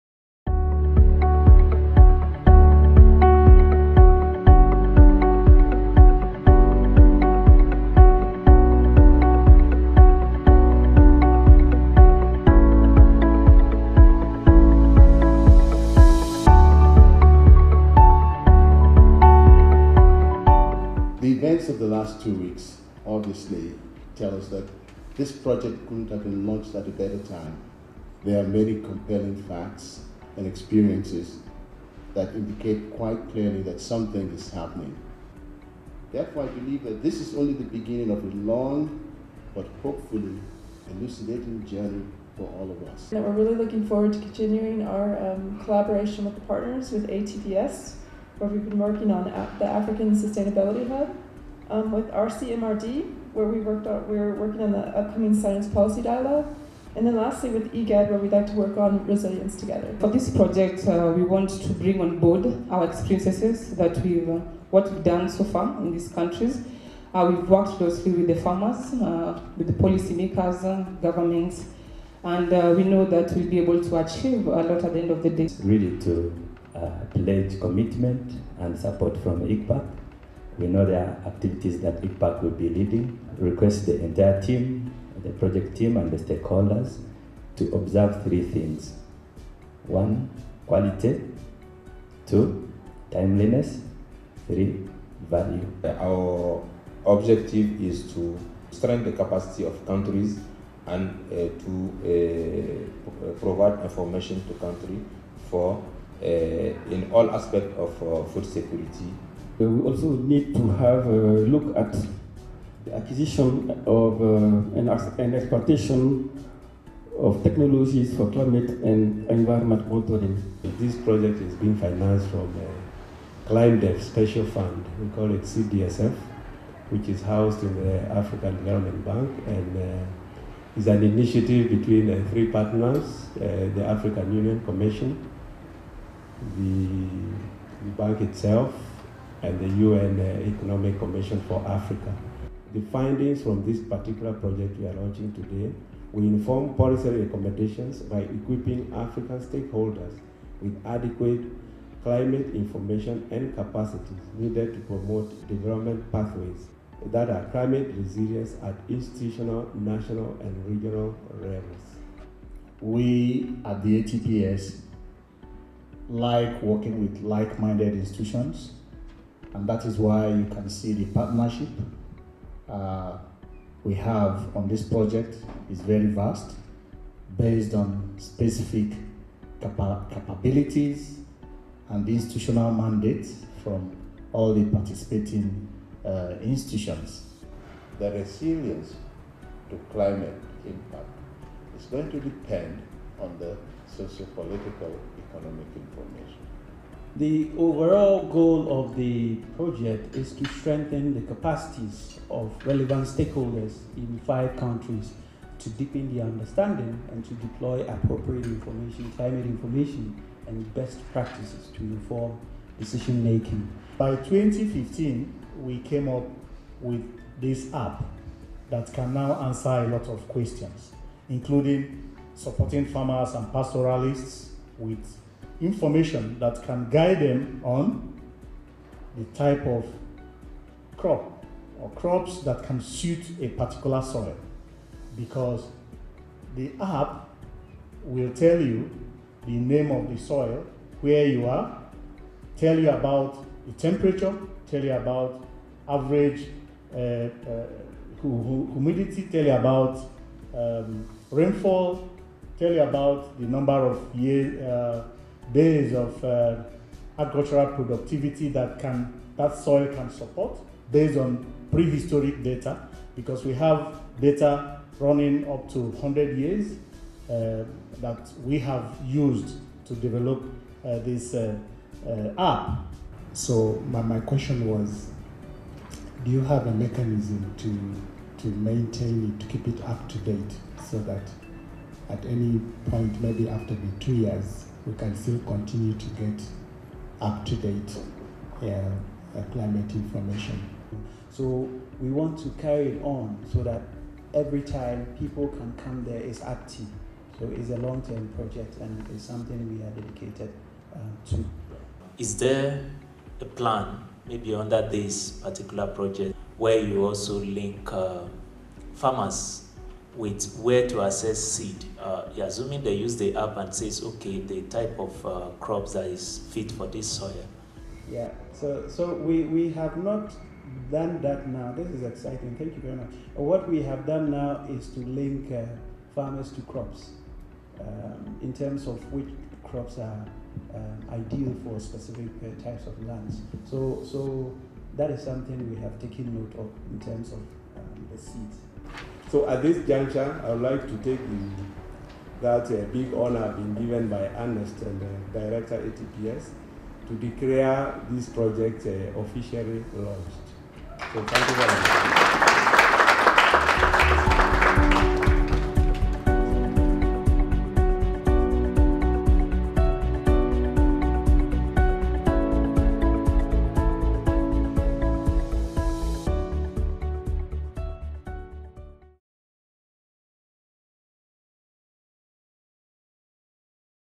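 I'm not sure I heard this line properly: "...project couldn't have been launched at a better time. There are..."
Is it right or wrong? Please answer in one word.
right.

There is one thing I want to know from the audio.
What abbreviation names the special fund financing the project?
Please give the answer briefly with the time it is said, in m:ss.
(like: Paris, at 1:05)
CDSF, at 2:05.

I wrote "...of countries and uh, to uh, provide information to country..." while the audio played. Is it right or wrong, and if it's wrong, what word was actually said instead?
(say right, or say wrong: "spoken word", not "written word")
right.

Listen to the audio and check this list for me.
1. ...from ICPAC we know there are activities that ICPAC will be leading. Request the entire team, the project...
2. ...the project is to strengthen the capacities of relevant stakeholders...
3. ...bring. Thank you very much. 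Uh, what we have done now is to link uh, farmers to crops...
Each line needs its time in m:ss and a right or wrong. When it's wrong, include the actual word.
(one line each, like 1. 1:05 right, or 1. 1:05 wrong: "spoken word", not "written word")
1. 1:19 right
2. 3:18 right
3. 5:22 wrong: "exciting", not "bring".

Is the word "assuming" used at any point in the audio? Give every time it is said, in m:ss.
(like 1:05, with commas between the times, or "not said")
5:12.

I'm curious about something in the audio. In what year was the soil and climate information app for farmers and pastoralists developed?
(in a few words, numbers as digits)
2015.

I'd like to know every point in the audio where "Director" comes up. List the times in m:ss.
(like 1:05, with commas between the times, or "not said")
5:45.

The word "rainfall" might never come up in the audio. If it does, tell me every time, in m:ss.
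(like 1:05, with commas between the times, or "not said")
4:11.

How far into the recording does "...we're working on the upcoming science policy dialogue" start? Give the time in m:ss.
0:54.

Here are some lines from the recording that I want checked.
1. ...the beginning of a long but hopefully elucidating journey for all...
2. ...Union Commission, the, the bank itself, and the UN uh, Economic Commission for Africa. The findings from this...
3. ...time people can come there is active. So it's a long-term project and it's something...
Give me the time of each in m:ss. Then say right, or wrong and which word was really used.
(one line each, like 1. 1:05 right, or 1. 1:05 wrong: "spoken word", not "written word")
1. 0:37 right
2. 2:14 right
3. 4:54 right.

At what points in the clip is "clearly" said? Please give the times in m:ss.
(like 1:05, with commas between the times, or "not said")
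0:33.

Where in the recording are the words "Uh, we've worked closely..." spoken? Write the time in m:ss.
1:07.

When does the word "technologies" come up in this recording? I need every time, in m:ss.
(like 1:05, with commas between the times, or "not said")
1:57.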